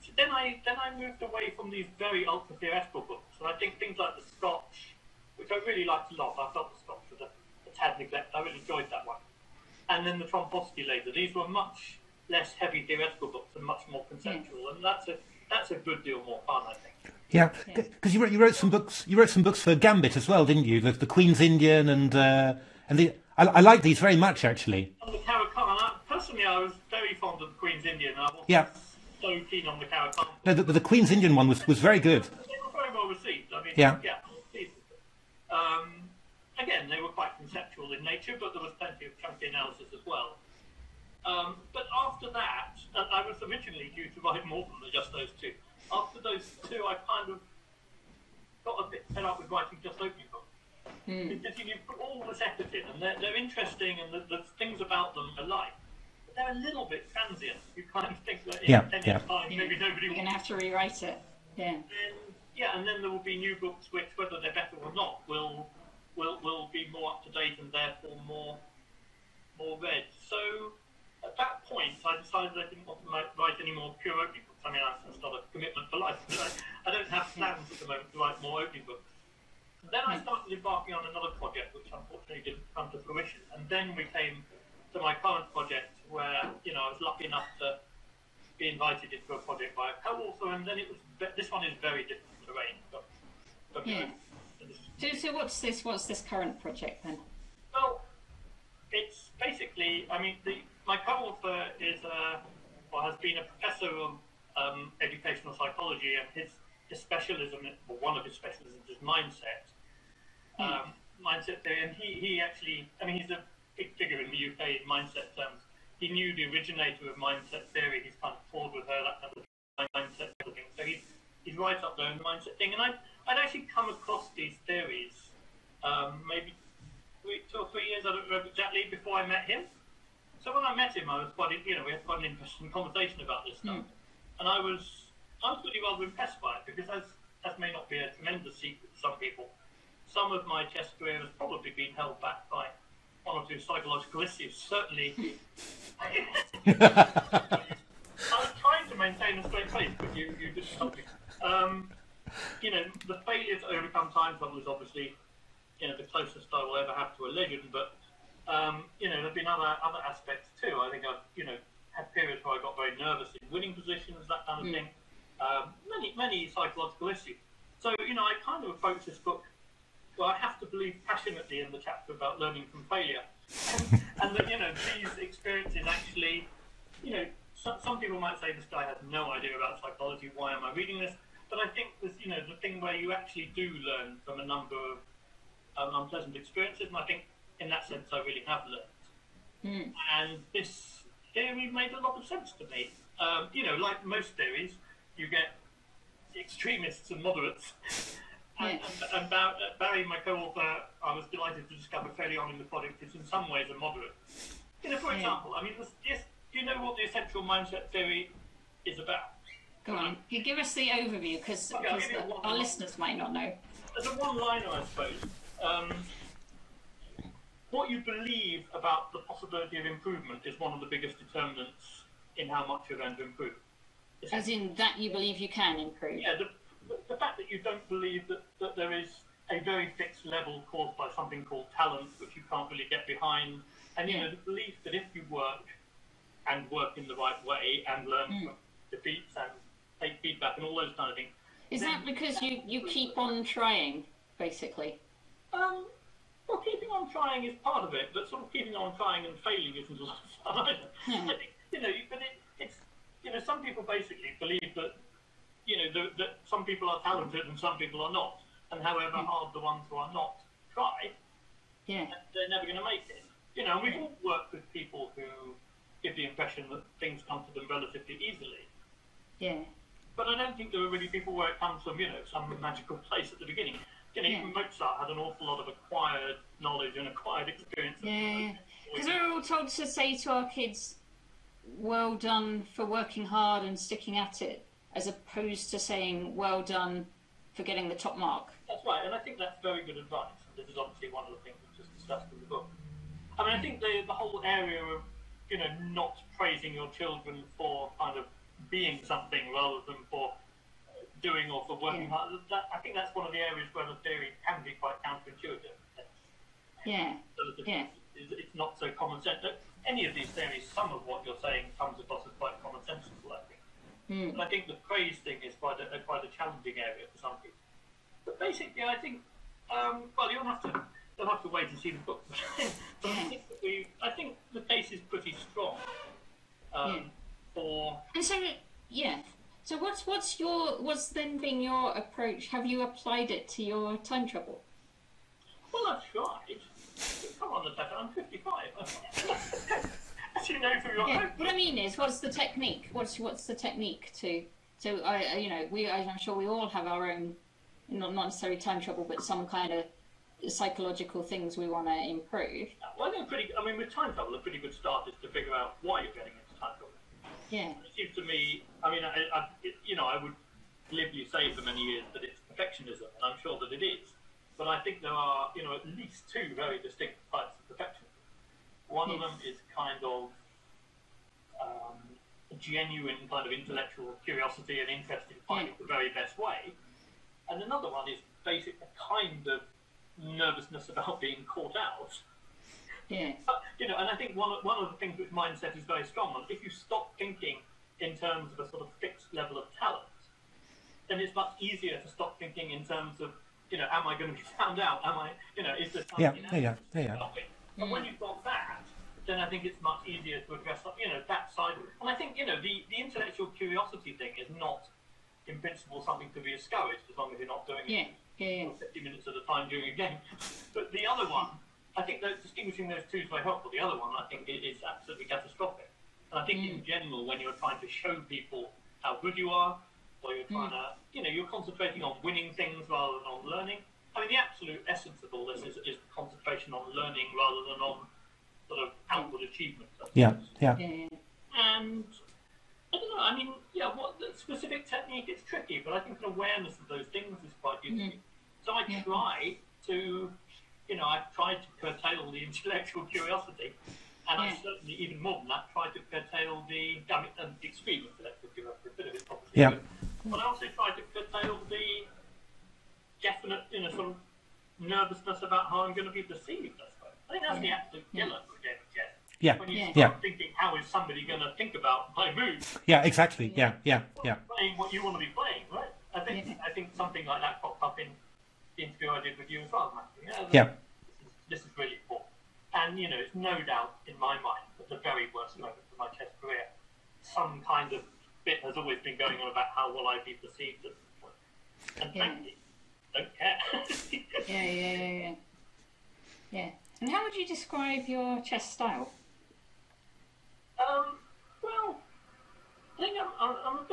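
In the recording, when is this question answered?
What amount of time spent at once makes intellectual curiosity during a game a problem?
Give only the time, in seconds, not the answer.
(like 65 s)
408 s.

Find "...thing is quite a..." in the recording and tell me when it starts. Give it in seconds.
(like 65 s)
315 s.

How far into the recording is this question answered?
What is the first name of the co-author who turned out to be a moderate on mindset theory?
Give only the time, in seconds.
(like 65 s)
199 s.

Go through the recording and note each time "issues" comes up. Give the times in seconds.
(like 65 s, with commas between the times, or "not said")
144 s, 167 s.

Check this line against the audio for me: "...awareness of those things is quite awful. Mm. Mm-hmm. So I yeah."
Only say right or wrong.
wrong.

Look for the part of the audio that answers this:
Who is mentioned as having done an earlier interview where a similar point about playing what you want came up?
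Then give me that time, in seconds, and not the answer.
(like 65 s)
469 s.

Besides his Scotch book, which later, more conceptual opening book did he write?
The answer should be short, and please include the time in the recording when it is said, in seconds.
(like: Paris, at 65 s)
Trompowsky, at 10 s.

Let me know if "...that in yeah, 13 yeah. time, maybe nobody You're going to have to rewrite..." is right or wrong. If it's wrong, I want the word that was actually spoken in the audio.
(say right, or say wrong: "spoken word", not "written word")
wrong: "10", not "13".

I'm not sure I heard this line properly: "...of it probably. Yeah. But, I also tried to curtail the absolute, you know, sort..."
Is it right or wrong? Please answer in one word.
wrong.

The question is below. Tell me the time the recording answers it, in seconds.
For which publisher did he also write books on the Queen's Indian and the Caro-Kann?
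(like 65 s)
19 s.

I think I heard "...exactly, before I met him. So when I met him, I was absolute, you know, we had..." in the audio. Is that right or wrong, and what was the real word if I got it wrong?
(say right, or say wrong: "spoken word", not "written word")
wrong: "quite", not "absolute".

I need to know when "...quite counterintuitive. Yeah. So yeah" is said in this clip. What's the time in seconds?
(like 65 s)
304 s.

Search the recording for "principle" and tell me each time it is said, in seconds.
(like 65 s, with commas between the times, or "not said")
405 s.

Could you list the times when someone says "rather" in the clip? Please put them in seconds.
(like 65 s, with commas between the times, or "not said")
135 s, 299 s, 422 s, 427 s.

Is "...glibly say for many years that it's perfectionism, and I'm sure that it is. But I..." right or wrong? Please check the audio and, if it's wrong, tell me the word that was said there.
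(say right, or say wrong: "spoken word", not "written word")
right.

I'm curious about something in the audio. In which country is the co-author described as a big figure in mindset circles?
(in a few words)
UK.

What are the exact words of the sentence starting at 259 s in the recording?
hard the ones who are not try, yeah, they're never going to make it.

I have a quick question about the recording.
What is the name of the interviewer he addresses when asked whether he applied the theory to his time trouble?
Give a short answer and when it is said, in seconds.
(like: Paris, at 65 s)
Natasha, at 337 s.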